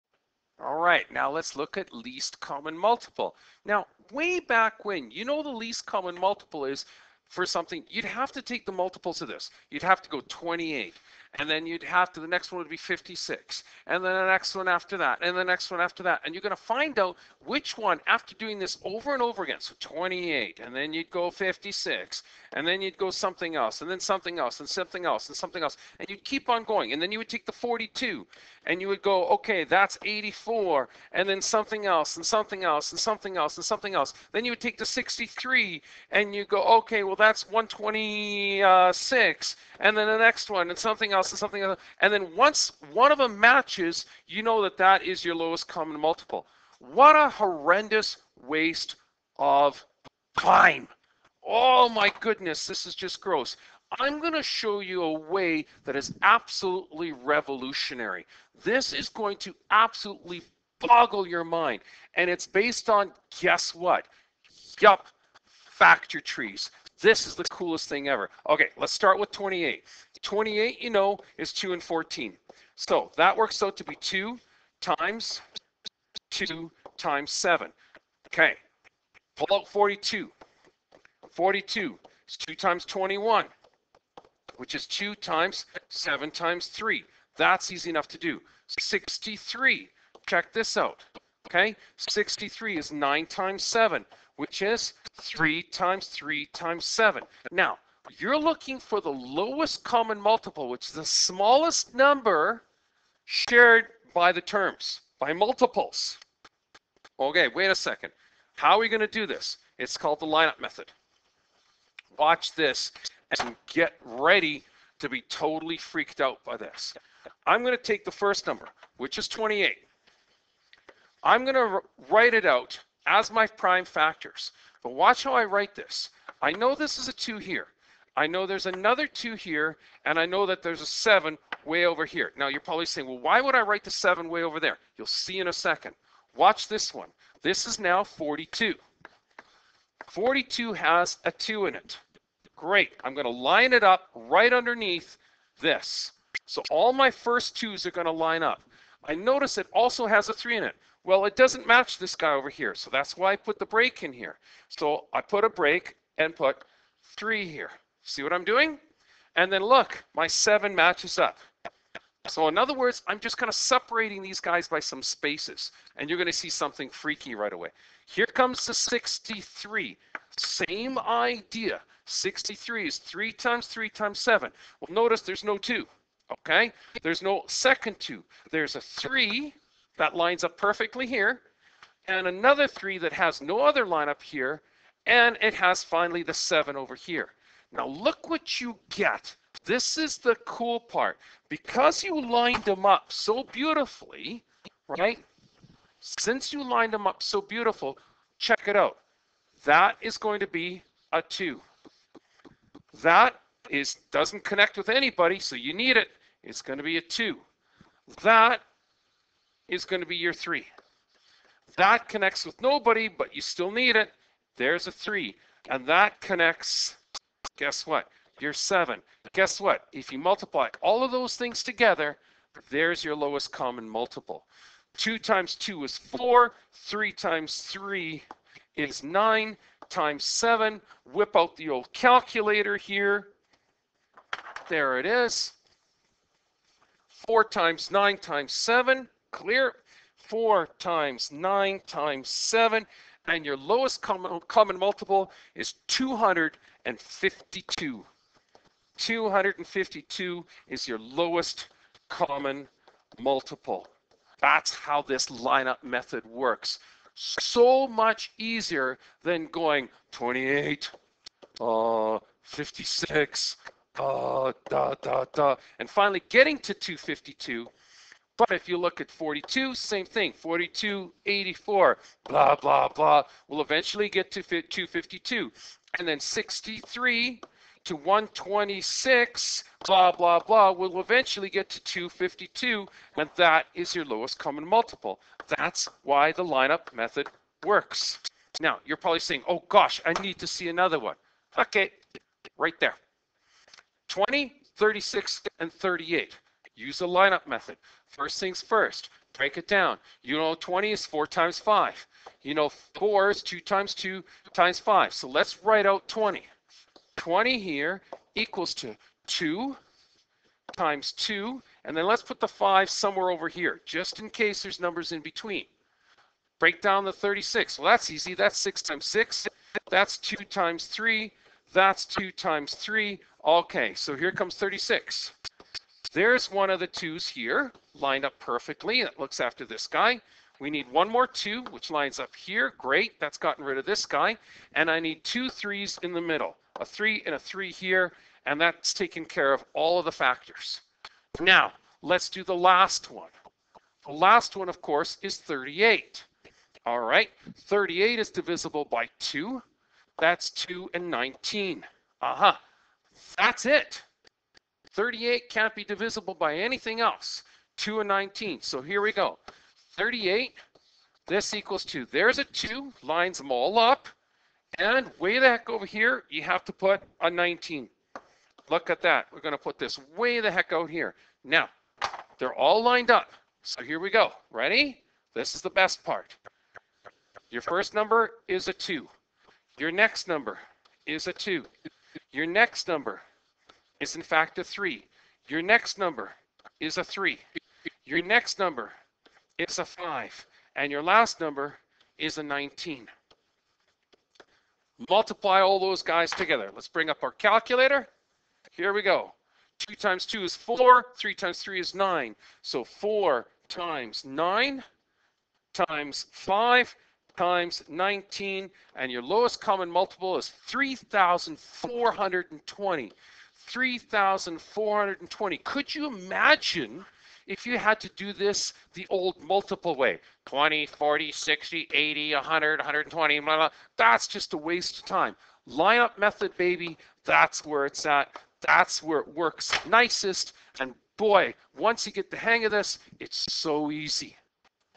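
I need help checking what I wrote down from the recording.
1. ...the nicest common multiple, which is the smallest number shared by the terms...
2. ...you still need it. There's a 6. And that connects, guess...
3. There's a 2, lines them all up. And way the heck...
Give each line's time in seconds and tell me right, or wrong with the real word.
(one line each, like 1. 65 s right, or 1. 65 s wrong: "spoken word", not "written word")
1. 99 s wrong: "lowest", not "nicest"
2. 213 s wrong: "3", not "6"
3. 362 s right.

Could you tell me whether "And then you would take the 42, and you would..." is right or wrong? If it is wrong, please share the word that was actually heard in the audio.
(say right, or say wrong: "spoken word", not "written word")
right.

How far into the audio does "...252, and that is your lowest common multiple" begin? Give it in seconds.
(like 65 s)
281 s.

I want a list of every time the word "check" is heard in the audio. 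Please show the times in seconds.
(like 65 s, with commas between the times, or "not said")
90 s, 198 s.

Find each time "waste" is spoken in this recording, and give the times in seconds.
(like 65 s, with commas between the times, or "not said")
48 s, 424 s.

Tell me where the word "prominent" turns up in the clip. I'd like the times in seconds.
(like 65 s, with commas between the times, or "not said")
not said.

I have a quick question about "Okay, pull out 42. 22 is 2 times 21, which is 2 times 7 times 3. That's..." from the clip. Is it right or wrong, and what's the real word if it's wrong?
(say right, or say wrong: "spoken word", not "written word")
wrong: "42", not "22".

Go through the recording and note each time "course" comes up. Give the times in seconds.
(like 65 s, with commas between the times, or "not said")
344 s.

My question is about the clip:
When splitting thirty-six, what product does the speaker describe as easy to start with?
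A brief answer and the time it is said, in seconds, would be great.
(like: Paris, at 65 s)
6 times 6, at 318 s.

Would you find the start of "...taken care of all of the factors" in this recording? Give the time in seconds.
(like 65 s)
338 s.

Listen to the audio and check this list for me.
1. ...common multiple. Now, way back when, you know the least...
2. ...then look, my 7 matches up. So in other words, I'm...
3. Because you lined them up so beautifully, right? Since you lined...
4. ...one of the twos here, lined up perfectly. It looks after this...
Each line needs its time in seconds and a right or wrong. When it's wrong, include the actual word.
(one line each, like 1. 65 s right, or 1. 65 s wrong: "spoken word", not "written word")
1. 2 s right
2. 159 s right
3. 191 s right
4. 326 s right.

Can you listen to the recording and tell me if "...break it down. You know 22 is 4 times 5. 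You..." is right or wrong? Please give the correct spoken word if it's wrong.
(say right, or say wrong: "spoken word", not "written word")
wrong: "20", not "22".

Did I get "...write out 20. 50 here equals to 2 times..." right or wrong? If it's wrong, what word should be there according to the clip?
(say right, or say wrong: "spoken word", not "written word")
wrong: "20", not "50".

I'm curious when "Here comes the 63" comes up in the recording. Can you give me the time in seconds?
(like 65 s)
168 s.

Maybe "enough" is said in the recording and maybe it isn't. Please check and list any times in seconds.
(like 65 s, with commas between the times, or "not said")
87 s.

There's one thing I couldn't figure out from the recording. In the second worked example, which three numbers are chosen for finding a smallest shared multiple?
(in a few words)
20, 36, and 38.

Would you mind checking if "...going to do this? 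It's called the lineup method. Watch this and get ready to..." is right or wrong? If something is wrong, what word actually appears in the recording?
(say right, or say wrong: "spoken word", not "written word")
right.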